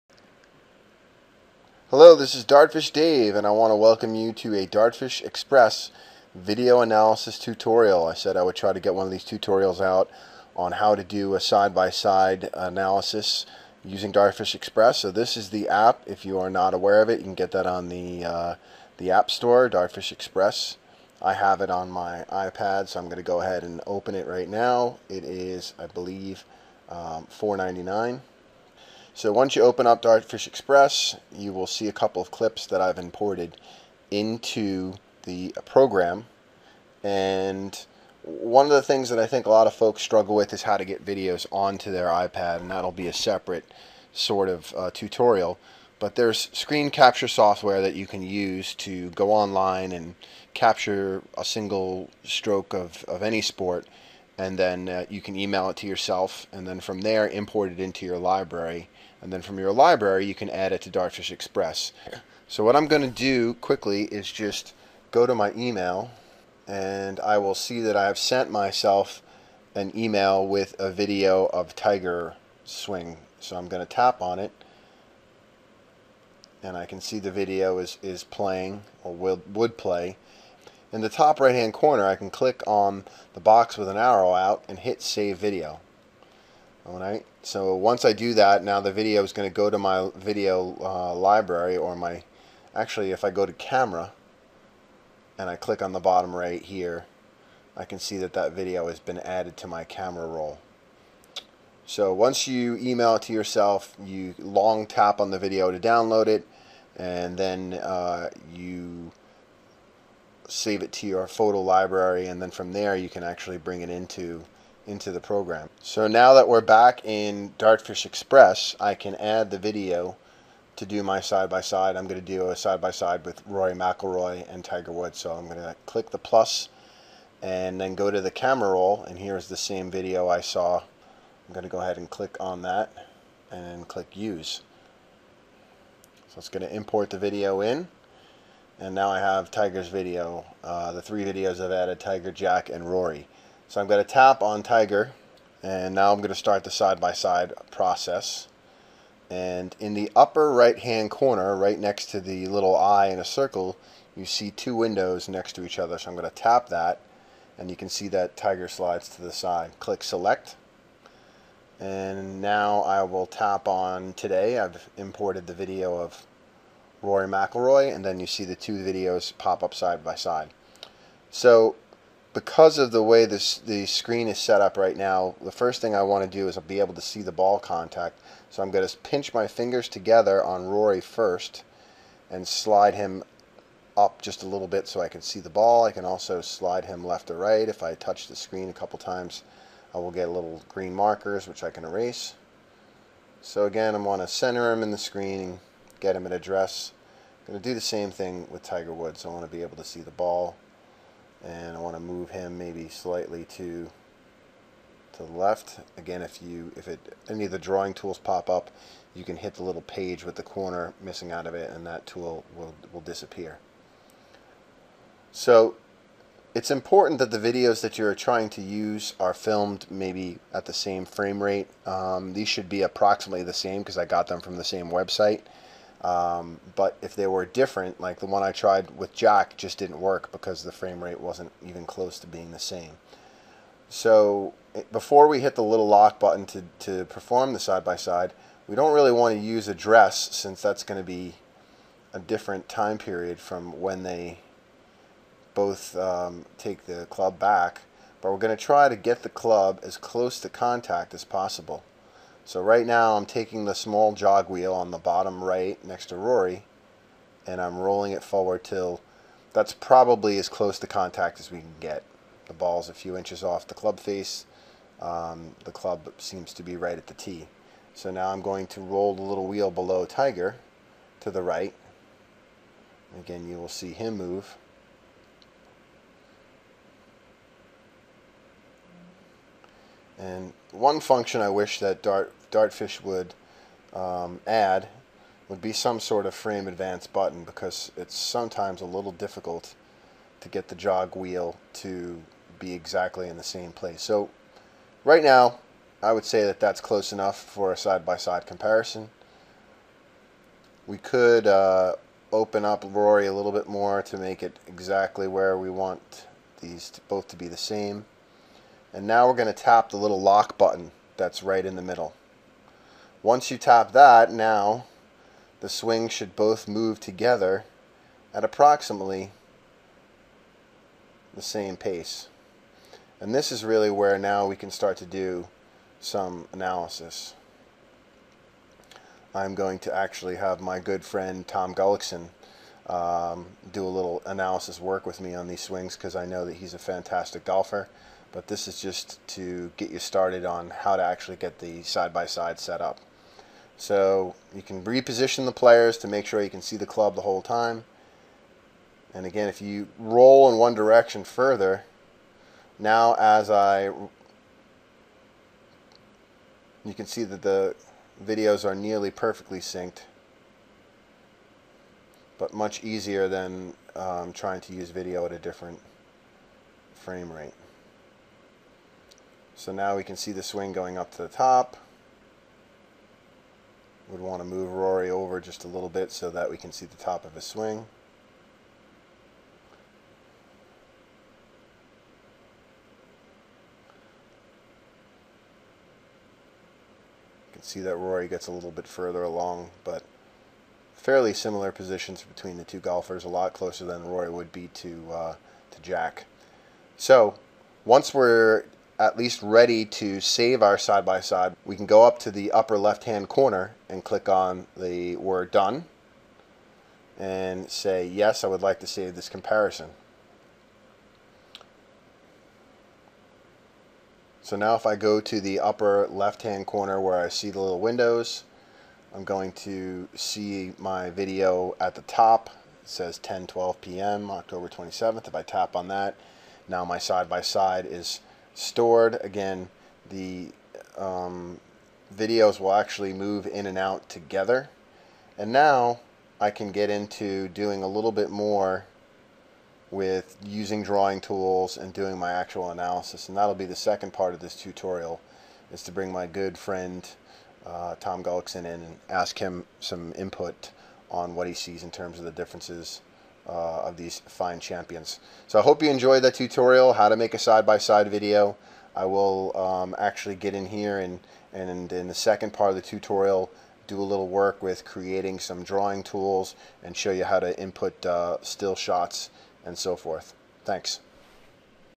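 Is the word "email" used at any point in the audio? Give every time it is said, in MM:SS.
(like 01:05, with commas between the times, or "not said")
00:55, 01:05, 01:09, 01:42.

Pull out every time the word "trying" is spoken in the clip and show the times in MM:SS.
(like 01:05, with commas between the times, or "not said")
03:38, 06:04.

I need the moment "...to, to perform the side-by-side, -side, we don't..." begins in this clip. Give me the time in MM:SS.
03:56.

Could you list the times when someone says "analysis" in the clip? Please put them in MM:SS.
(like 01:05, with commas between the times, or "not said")
00:06, 00:12, 05:26, 05:34, 07:22.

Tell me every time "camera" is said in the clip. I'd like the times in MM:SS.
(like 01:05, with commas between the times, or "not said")
01:33, 01:39, 02:08.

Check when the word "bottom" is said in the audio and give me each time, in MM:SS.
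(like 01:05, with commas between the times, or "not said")
01:36, 04:14.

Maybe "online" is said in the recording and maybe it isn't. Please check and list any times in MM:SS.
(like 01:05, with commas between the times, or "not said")
00:49.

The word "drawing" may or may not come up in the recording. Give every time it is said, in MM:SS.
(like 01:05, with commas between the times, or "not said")
03:27, 07:20, 07:45.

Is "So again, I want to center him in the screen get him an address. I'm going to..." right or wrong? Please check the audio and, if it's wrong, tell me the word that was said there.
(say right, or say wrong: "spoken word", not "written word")
right.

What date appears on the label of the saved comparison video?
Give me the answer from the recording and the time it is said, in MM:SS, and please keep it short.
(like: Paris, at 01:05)
October 27th, at 07:04.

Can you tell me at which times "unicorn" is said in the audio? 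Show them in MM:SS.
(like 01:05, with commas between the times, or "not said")
not said.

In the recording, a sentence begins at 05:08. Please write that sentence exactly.
And now we're going to tap the little lock button that's right in the middle.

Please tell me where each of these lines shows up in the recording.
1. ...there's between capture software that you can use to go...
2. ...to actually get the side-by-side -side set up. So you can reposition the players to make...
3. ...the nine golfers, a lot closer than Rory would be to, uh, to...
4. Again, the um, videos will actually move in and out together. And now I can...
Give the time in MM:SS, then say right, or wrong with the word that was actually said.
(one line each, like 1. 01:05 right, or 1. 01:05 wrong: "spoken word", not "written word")
1. 00:46 wrong: "screen", not "between"
2. 05:40 right
3. 06:32 wrong: "two", not "nine"
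4. 07:09 right.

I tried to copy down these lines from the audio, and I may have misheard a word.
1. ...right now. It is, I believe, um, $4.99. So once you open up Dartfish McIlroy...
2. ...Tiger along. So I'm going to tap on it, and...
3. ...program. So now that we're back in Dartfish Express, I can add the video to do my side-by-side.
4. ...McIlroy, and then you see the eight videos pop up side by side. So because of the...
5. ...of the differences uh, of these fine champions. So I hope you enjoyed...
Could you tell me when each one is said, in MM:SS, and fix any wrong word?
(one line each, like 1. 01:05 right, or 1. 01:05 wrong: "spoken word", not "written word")
1. 00:24 wrong: "Express", not "McIlroy"
2. 01:11 wrong: "swing", not "along"
3. 01:55 right
4. 02:47 wrong: "two", not "eight"
5. 07:32 right.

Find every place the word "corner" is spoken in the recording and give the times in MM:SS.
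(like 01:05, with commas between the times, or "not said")
01:21, 02:31, 03:30, 06:43, 06:56.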